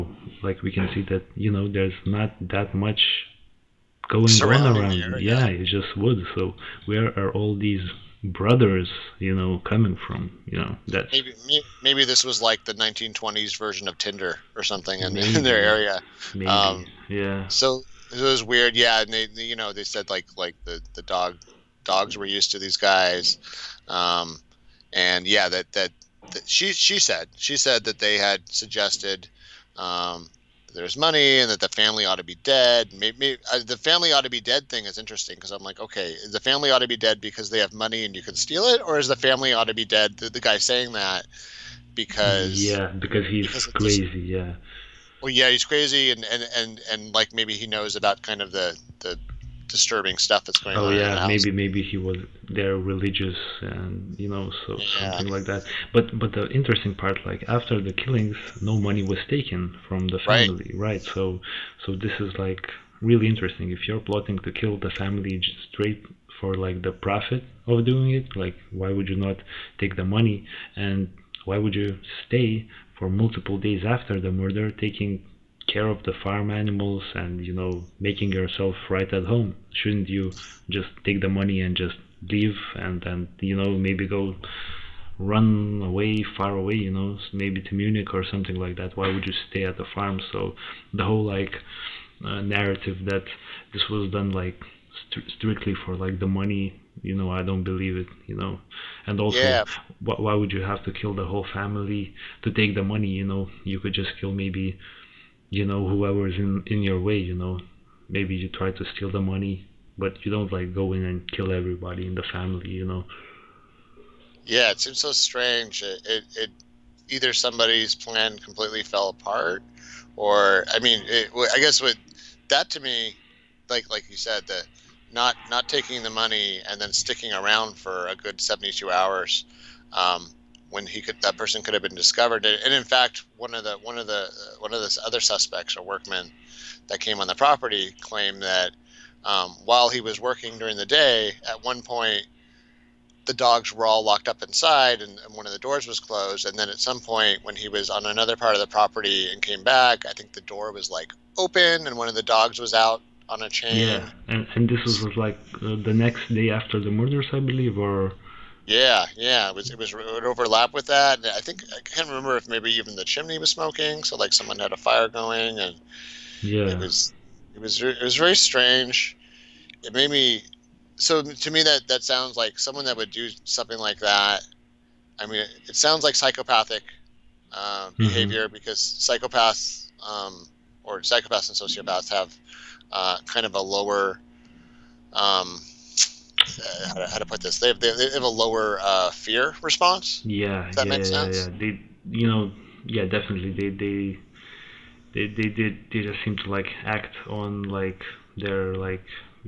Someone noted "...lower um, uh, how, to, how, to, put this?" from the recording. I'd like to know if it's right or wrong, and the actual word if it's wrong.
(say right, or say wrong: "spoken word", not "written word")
right.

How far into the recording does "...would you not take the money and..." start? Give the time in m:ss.
1:08.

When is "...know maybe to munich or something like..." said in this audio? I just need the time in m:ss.
1:26.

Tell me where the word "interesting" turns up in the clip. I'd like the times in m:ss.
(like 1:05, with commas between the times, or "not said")
0:34, 0:56, 1:03.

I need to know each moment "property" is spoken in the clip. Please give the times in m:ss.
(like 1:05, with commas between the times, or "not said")
2:17, 2:28.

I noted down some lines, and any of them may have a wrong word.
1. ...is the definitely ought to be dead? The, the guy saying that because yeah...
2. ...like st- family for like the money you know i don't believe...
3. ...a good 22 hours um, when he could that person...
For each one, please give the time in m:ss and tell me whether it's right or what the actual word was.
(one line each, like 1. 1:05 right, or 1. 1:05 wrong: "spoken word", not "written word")
1. 0:38 wrong: "family", not "definitely"
2. 1:34 wrong: "strictly", not "family"
3. 2:08 wrong: "72", not "22".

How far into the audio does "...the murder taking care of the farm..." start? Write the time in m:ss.
1:14.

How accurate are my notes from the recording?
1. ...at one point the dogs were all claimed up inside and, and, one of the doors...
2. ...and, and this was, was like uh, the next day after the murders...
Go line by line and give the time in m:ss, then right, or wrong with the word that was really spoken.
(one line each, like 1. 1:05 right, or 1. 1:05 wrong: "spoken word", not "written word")
1. 2:21 wrong: "locked", not "claimed"
2. 2:34 right.